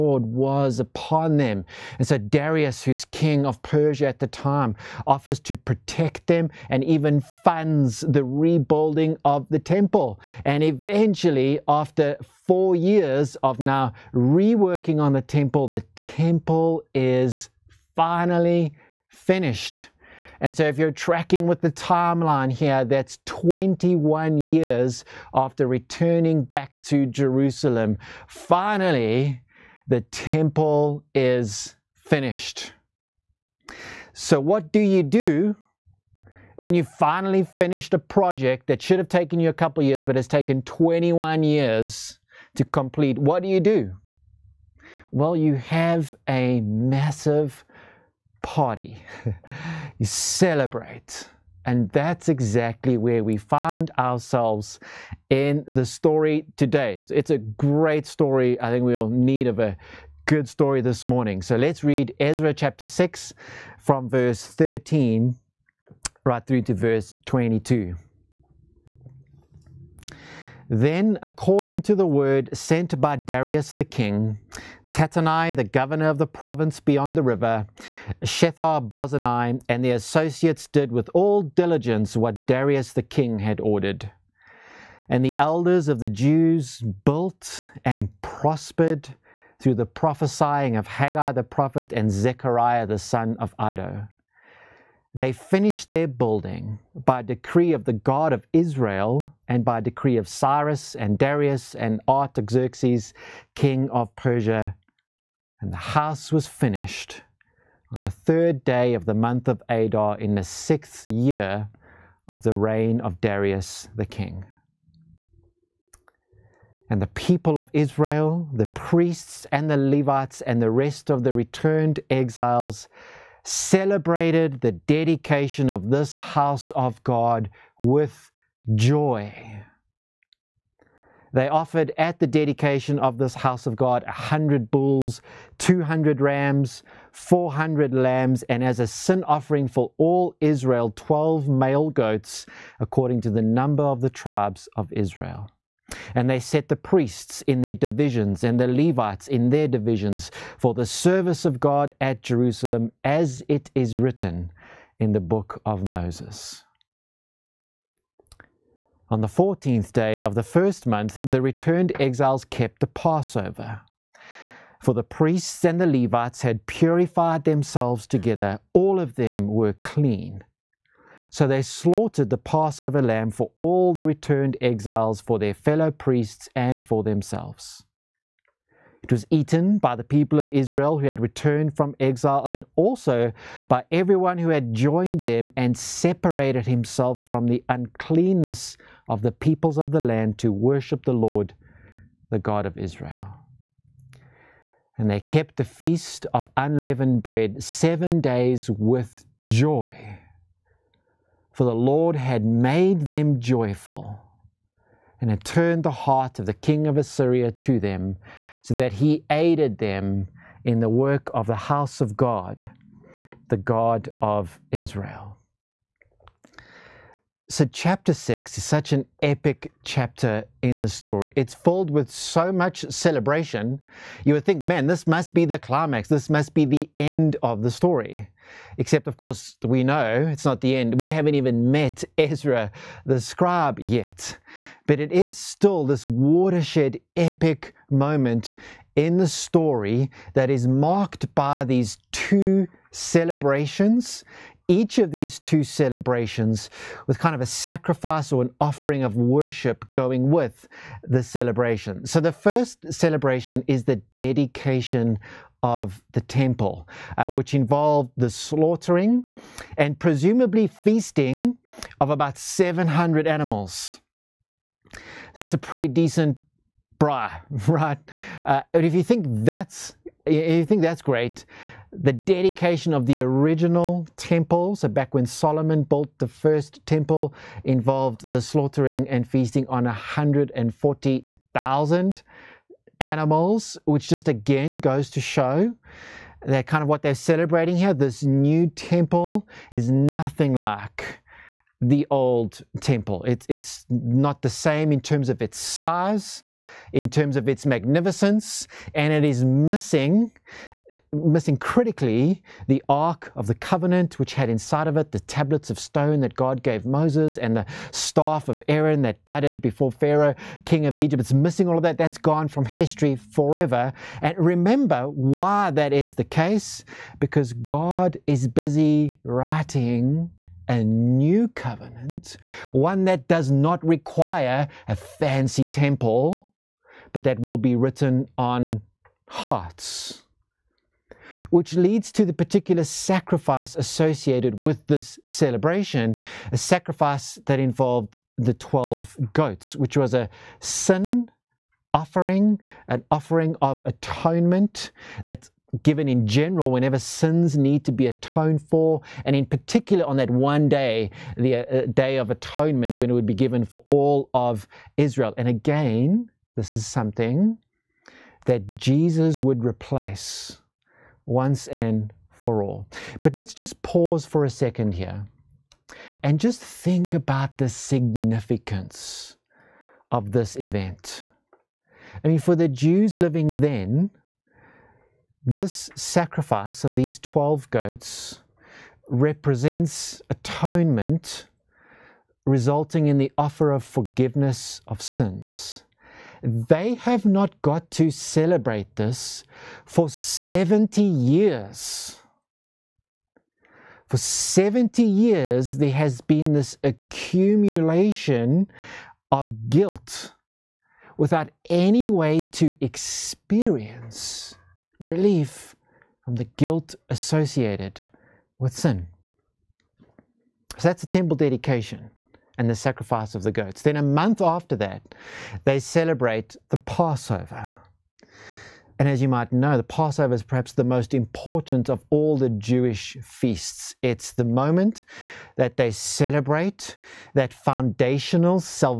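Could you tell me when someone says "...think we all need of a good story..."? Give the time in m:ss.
0:58.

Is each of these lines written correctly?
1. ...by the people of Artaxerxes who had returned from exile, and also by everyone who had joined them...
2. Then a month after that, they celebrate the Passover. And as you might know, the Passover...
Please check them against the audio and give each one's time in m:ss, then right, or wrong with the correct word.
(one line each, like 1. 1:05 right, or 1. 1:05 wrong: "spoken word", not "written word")
1. 2:59 wrong: "Israel", not "Artaxerxes"
2. 6:53 right.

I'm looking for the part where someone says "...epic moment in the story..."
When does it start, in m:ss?
3:57.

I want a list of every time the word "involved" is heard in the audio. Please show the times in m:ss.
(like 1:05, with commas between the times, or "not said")
4:17, 4:37, 5:37.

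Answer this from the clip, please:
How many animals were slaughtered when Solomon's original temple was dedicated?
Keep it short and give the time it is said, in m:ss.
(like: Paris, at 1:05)
140,000, at 4:39.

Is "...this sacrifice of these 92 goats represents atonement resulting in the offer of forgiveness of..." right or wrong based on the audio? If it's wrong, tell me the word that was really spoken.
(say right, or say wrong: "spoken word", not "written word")
wrong: "12", not "92".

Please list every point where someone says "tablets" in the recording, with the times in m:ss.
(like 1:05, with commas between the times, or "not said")
5:05.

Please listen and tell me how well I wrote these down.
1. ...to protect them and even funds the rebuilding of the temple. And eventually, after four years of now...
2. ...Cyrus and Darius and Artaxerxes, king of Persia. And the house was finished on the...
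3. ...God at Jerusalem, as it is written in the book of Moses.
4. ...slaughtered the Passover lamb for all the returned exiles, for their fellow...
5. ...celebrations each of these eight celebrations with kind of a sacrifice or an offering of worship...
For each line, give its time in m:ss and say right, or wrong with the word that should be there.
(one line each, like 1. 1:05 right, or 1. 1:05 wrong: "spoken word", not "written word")
1. 0:05 right
2. 1:40 right
3. 2:31 right
4. 2:51 right
5. 4:02 wrong: "two", not "eight".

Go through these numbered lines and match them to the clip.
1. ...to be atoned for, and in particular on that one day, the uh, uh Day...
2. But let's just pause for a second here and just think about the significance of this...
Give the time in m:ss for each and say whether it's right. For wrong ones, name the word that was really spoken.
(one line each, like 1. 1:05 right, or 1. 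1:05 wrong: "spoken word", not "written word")
1. 5:47 right
2. 6:03 right.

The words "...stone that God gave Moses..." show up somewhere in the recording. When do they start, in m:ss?
5:05.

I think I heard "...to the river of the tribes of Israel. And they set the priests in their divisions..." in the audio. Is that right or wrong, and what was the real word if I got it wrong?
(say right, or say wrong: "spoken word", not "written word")
wrong: "number", not "river".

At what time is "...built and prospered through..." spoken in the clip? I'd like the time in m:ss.
1:27.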